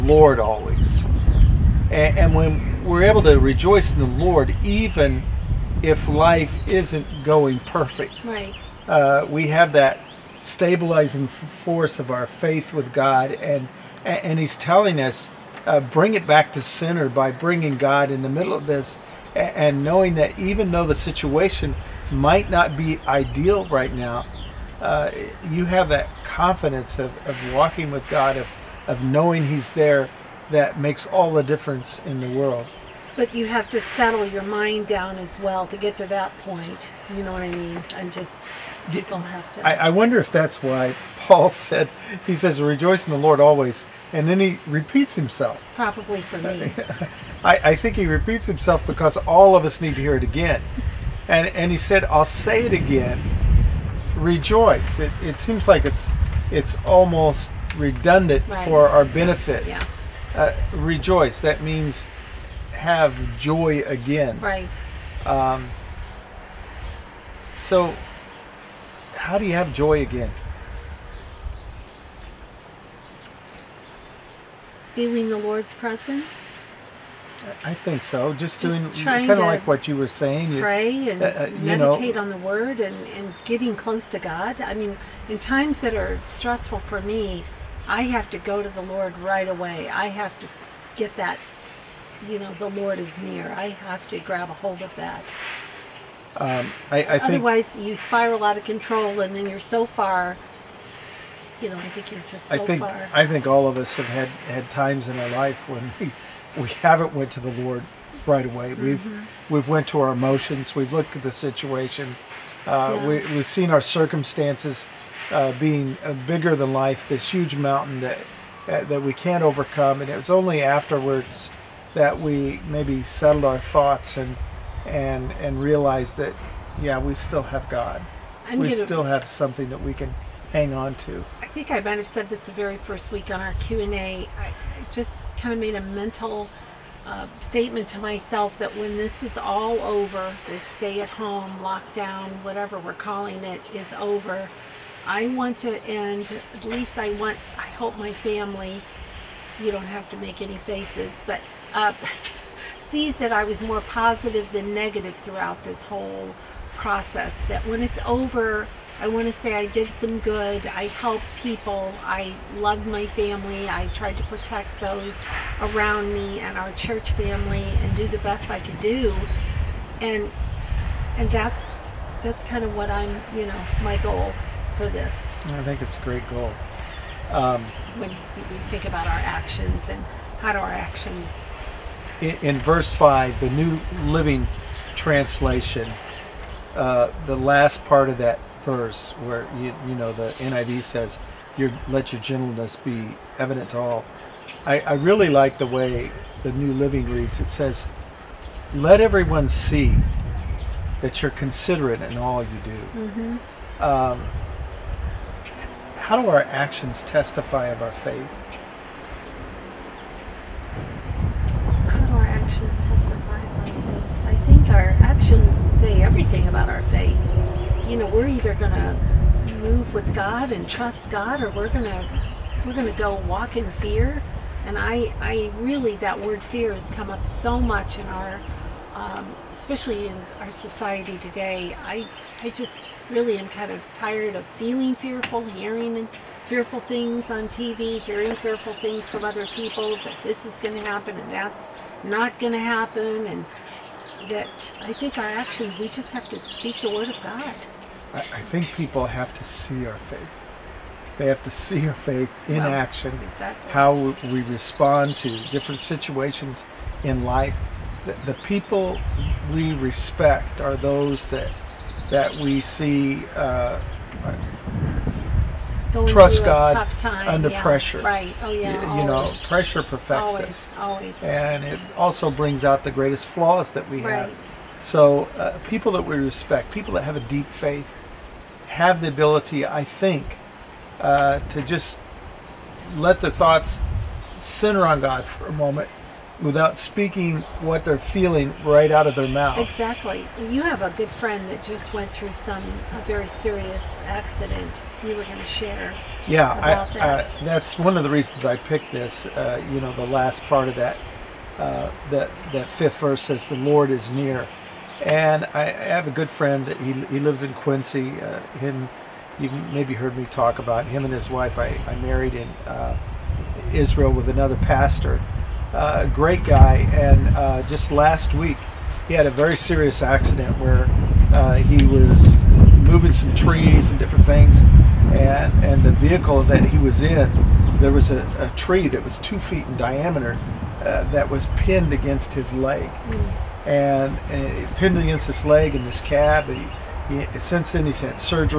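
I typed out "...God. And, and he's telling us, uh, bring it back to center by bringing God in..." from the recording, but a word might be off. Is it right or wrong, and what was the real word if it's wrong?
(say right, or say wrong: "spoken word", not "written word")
right.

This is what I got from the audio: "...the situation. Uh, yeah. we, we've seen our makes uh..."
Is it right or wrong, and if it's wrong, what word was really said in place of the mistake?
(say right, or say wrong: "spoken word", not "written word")
wrong: "circumstances", not "makes".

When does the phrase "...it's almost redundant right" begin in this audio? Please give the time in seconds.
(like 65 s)
56 s.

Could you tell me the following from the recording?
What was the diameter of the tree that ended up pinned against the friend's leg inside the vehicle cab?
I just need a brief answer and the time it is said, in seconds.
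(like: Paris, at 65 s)
2 feet, at 329 s.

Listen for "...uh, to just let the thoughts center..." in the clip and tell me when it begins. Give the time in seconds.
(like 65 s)
280 s.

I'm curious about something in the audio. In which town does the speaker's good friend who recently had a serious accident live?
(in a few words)
Quincy.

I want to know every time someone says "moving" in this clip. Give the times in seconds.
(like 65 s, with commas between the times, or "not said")
322 s.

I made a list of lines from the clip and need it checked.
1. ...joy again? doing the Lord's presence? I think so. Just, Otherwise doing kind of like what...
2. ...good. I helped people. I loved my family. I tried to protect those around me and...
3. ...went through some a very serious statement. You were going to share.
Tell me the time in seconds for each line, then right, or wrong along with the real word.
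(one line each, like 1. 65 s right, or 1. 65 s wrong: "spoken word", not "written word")
1. 69 s wrong: "Just", not "Otherwise"
2. 160 s right
3. 291 s wrong: "accident", not "statement".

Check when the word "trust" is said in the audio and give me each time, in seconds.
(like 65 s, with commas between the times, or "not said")
220 s, 266 s.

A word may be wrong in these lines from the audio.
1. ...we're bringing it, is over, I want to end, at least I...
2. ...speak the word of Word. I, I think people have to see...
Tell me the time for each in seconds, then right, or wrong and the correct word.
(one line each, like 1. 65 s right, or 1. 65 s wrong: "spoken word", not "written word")
1. 142 s wrong: "calling", not "bringing"
2. 246 s wrong: "God", not "Word".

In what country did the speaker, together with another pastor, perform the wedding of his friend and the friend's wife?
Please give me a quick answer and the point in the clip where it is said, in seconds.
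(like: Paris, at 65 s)
Israel, at 313 s.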